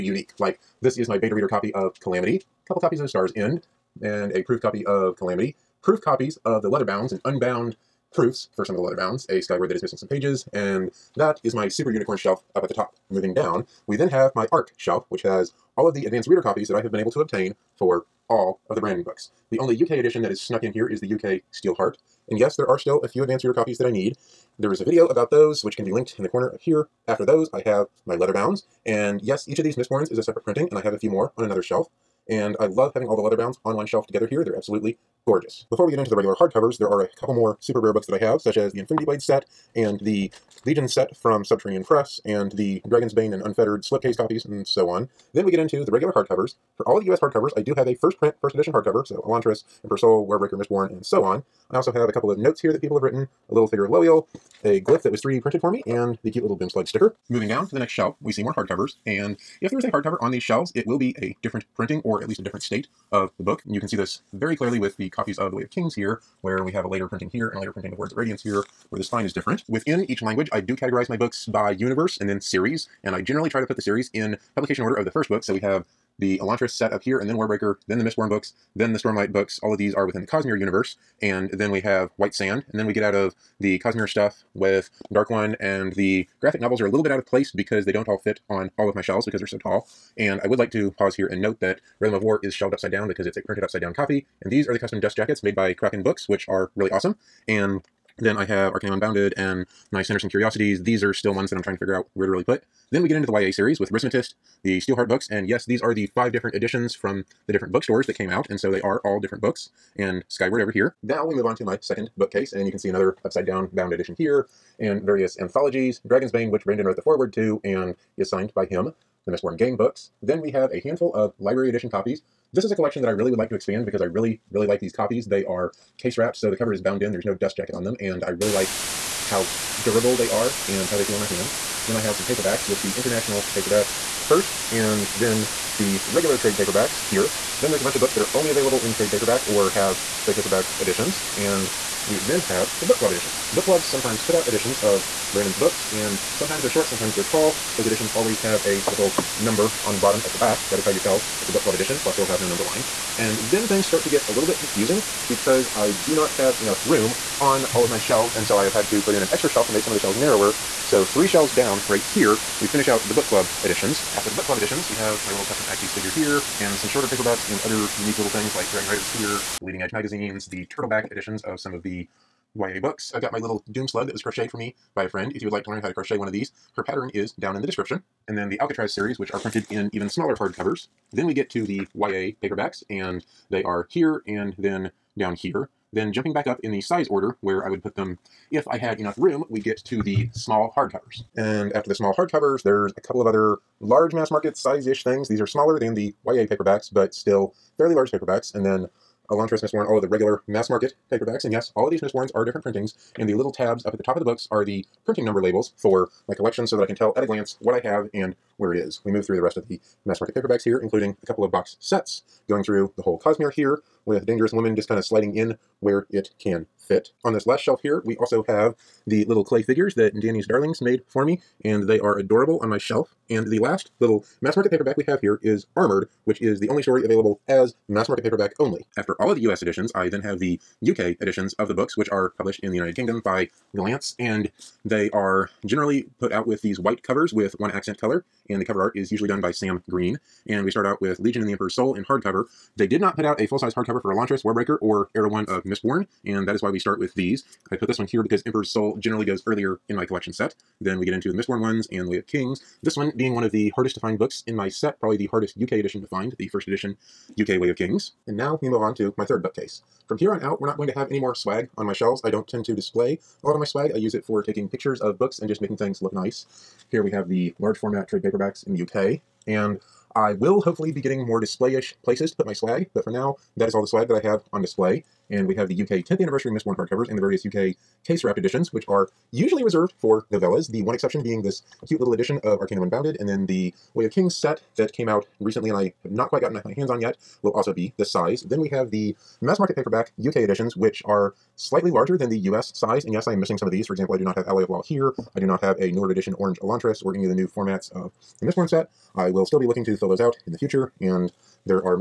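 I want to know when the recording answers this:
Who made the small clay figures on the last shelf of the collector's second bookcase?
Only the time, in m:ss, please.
3:40.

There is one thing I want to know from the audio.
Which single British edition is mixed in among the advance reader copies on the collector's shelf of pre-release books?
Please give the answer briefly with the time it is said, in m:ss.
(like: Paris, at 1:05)
UK Steelheart, at 0:21.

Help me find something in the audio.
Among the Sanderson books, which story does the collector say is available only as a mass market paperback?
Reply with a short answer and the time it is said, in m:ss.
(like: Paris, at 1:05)
Armored, at 3:45.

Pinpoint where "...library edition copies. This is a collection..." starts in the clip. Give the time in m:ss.
2:01.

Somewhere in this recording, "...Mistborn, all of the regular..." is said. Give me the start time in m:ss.
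3:19.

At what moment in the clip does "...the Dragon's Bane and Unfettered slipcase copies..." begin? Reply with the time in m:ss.
0:42.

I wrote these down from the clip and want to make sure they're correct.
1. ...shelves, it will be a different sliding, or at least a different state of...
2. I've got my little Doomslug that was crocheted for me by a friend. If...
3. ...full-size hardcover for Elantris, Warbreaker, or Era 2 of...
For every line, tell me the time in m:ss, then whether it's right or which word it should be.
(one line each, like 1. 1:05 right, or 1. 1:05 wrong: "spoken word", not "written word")
1. 1:00 wrong: "printing", not "sliding"
2. 2:53 right
3. 4:03 wrong: "1", not "2".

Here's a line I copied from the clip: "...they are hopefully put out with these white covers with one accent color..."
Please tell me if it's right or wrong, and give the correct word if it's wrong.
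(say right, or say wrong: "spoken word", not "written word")
wrong: "generally", not "hopefully".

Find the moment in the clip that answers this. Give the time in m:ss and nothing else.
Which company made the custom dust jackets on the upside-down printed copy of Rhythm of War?
1:35.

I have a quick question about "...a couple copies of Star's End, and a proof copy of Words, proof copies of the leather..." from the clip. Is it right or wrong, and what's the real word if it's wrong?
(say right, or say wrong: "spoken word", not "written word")
wrong: "Calamity", not "Words".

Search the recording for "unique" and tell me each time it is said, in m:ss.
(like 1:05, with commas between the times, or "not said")
0:00, 2:47.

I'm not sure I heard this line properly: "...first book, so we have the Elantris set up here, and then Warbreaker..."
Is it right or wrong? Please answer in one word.
right.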